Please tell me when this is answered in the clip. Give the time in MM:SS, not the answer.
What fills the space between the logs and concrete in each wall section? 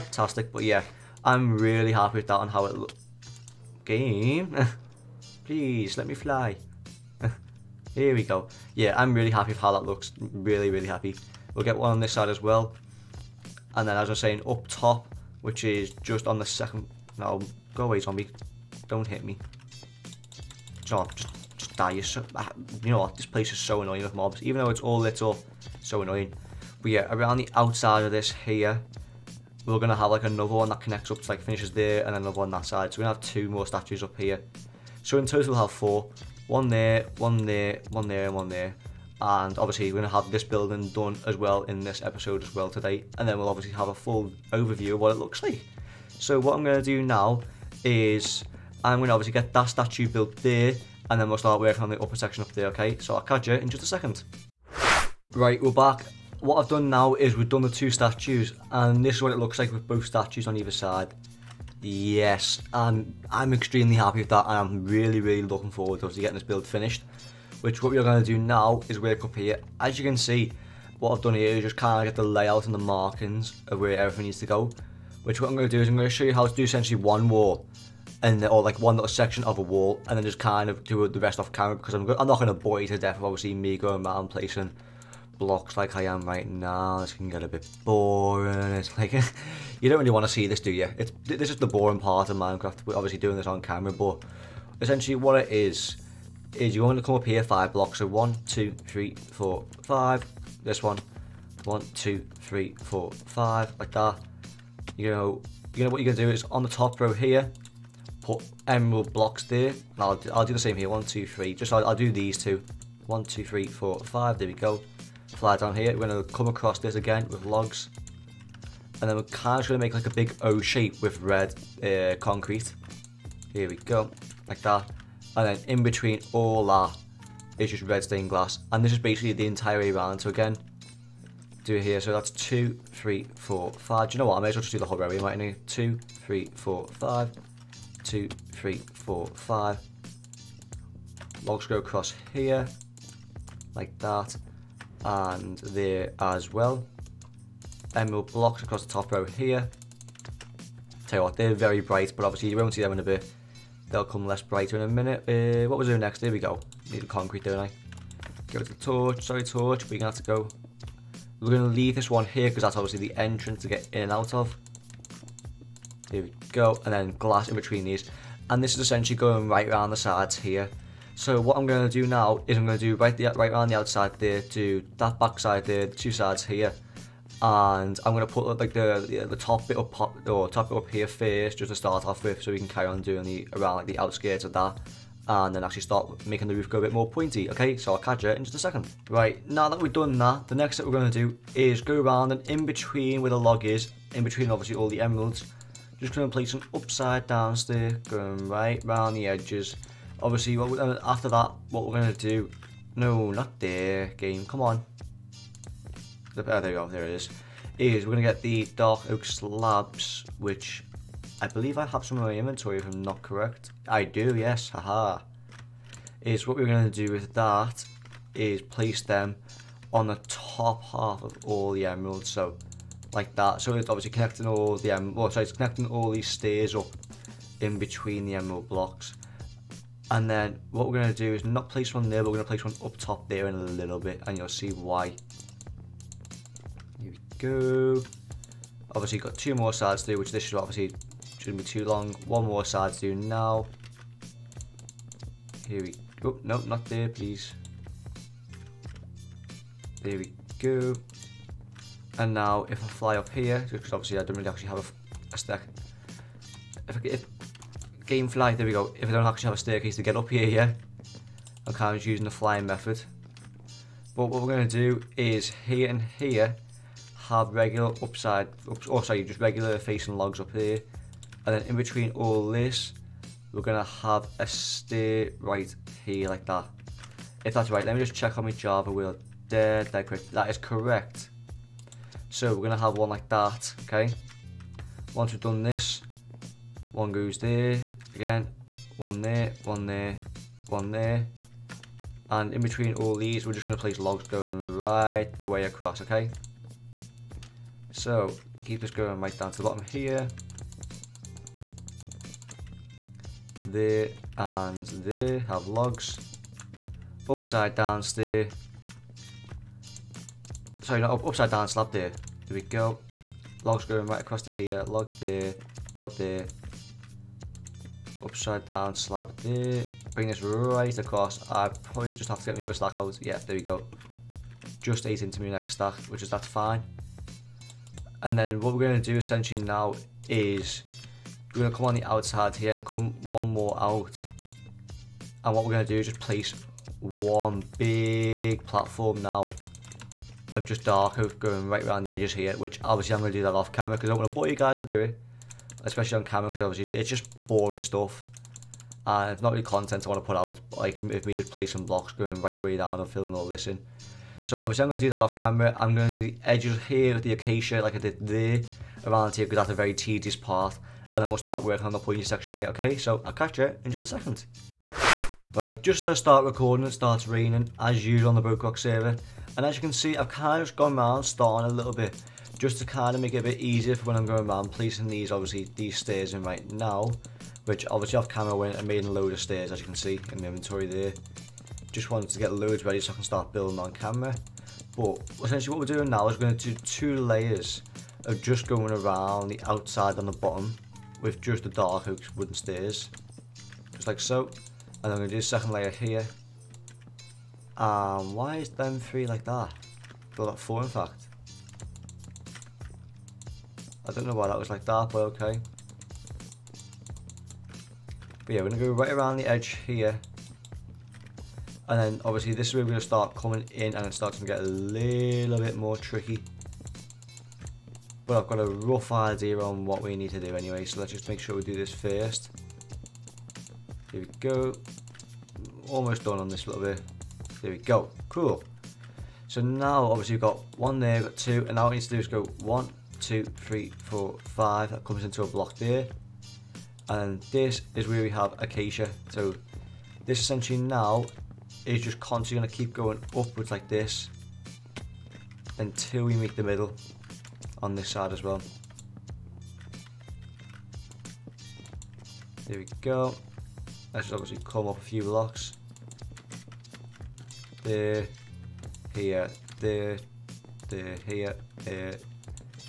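02:07.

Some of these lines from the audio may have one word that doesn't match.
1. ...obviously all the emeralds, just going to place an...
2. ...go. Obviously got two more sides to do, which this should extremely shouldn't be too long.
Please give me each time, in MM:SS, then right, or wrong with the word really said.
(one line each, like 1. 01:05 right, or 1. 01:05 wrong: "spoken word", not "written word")
1. 03:14 right
2. 03:57 wrong: "obviously", not "extremely".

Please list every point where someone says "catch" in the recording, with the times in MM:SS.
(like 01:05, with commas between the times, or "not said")
00:53, 03:07, 06:03.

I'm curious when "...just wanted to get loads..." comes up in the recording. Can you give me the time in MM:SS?
06:21.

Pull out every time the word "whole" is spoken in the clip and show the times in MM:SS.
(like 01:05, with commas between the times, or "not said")
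02:14.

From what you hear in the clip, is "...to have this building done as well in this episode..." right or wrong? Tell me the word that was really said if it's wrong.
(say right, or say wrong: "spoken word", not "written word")
right.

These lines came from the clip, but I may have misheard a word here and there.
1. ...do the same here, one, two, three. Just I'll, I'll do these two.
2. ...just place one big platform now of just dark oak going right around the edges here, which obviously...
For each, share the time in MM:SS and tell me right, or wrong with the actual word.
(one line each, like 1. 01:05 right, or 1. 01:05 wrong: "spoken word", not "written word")
1. 01:50 right
2. 05:36 right.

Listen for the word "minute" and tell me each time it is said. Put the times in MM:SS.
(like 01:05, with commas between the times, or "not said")
02:34.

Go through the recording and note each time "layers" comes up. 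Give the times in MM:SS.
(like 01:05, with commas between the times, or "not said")
06:27, 06:35.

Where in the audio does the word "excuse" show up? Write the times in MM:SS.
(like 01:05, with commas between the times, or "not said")
not said.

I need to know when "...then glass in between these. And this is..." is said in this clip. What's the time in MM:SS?
02:46.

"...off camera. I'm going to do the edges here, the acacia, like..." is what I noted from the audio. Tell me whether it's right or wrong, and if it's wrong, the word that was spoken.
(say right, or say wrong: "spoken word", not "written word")
right.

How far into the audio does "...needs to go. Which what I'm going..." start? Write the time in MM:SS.
01:14.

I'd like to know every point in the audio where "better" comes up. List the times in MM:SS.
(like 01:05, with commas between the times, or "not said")
not said.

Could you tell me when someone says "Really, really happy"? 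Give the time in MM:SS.
00:10.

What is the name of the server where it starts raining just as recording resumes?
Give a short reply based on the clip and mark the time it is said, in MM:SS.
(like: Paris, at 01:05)
BrokeRock, at 06:08.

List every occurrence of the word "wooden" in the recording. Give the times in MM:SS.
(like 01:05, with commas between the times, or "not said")
06:32.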